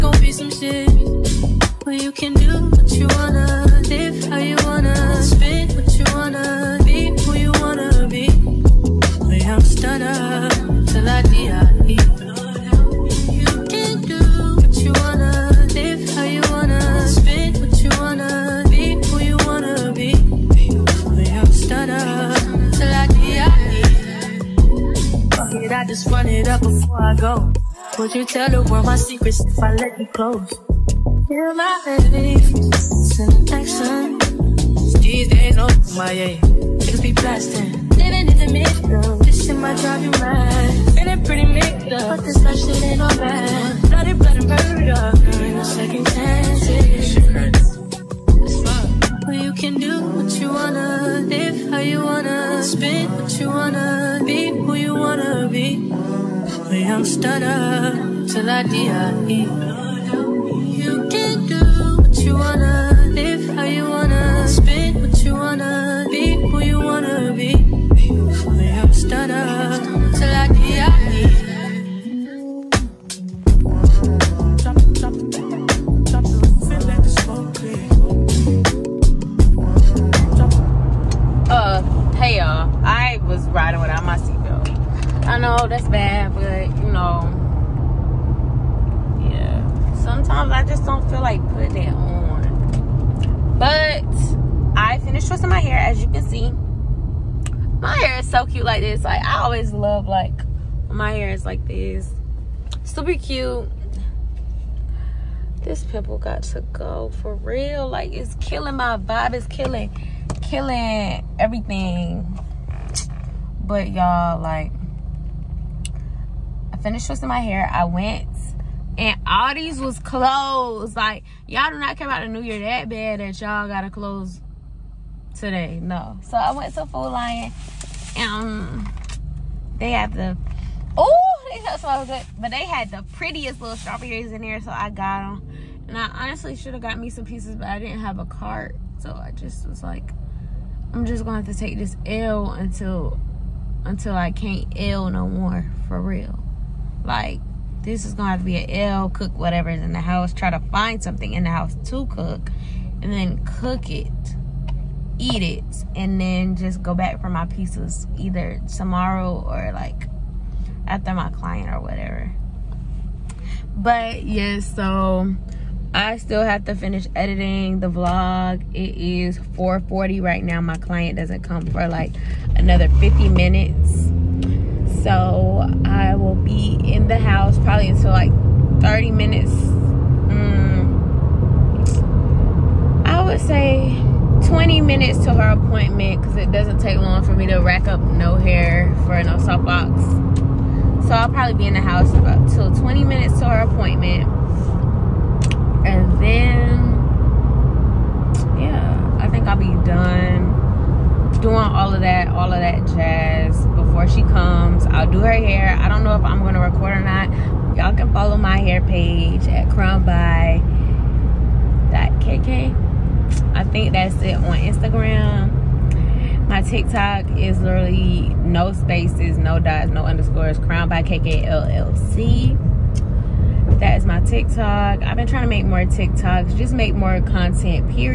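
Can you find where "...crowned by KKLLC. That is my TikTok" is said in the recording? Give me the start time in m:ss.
3:40.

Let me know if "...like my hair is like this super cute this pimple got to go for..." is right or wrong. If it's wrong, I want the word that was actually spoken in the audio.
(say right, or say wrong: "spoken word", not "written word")
right.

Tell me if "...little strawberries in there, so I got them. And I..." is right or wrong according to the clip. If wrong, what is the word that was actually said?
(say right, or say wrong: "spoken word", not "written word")
right.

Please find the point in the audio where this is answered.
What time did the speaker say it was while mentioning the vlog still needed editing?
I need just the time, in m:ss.
2:49.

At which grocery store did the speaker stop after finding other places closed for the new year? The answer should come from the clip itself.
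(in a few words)
Food Lion.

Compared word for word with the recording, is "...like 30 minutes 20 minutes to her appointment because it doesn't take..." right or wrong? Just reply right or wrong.
right.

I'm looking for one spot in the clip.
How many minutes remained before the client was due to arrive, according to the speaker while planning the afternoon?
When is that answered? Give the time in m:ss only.
2:52.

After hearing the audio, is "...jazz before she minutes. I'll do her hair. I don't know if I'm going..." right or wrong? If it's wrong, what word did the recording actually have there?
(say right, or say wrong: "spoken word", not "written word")
wrong: "comes", not "minutes".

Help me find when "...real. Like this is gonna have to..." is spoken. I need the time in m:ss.
2:26.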